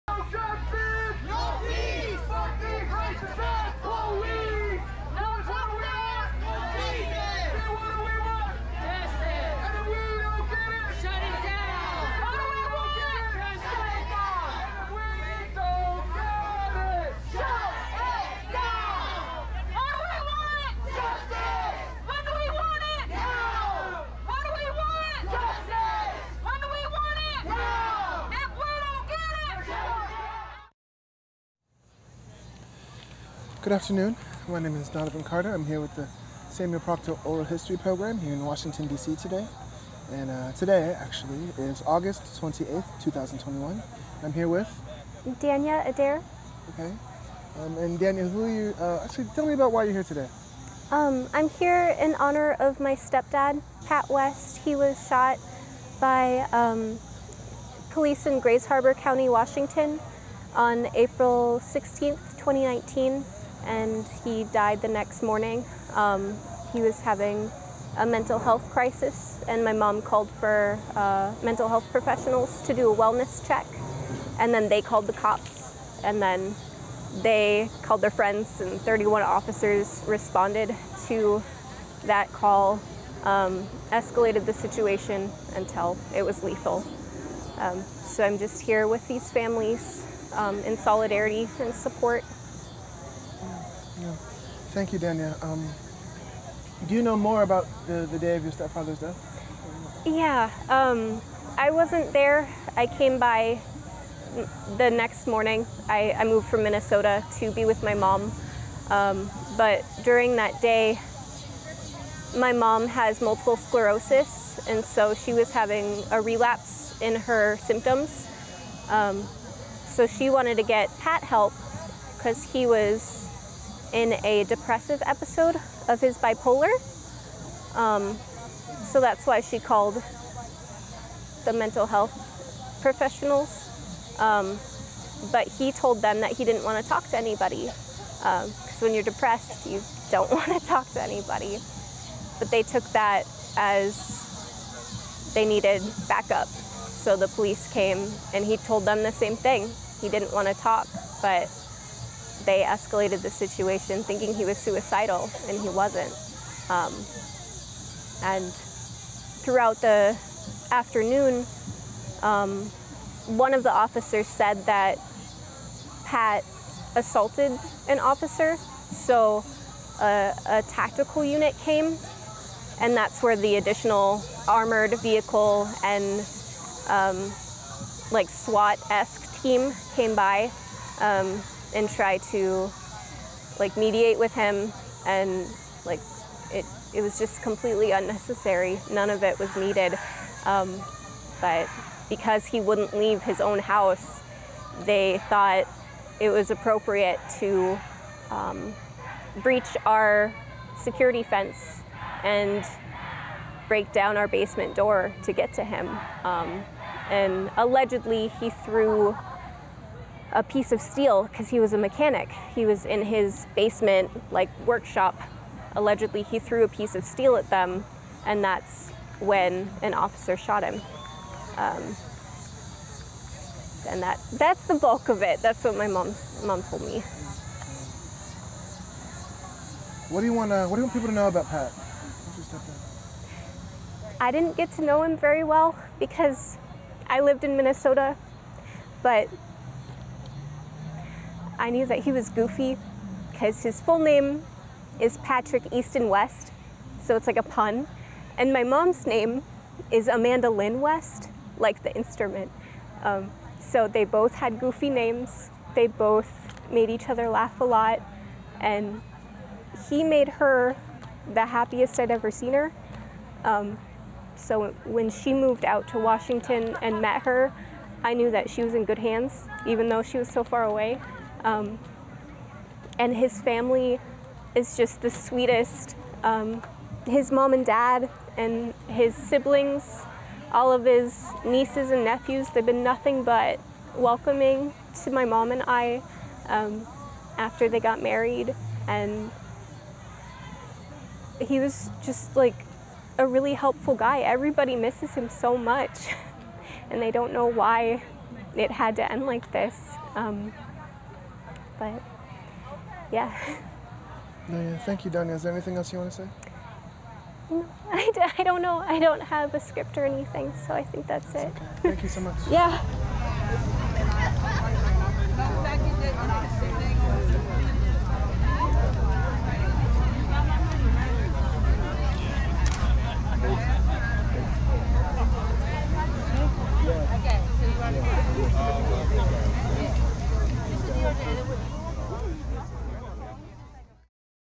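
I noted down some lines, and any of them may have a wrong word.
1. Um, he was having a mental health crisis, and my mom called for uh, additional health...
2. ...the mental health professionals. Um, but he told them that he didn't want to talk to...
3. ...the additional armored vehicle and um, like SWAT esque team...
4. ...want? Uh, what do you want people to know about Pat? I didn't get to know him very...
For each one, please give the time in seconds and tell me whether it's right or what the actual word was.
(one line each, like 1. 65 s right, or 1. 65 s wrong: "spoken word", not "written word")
1. 65 s wrong: "mental", not "additional"
2. 131 s right
3. 173 s right
4. 230 s right.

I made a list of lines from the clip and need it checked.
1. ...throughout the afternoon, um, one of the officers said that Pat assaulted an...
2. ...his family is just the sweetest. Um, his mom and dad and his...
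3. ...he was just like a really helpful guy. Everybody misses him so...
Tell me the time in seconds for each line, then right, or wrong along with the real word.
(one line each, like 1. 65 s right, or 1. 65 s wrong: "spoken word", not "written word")
1. 159 s right
2. 273 s right
3. 291 s right.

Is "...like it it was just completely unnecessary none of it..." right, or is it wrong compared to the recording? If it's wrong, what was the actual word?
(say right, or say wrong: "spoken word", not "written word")
right.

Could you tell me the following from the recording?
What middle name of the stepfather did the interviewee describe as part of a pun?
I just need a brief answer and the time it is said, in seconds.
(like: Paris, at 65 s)
Easton, at 245 s.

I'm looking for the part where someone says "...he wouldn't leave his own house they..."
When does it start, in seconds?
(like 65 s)
192 s.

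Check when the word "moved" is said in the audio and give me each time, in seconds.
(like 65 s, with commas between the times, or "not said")
106 s, 265 s.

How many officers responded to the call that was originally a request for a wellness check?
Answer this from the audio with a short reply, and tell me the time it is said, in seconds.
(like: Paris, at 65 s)
31, at 78 s.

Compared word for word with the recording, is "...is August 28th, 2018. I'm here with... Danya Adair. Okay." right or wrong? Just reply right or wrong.
wrong.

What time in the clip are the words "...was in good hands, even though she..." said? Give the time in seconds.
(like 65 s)
268 s.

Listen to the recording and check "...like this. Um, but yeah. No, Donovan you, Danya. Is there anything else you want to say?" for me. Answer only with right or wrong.
wrong.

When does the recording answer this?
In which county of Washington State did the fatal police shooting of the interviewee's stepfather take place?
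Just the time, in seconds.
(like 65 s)
58 s.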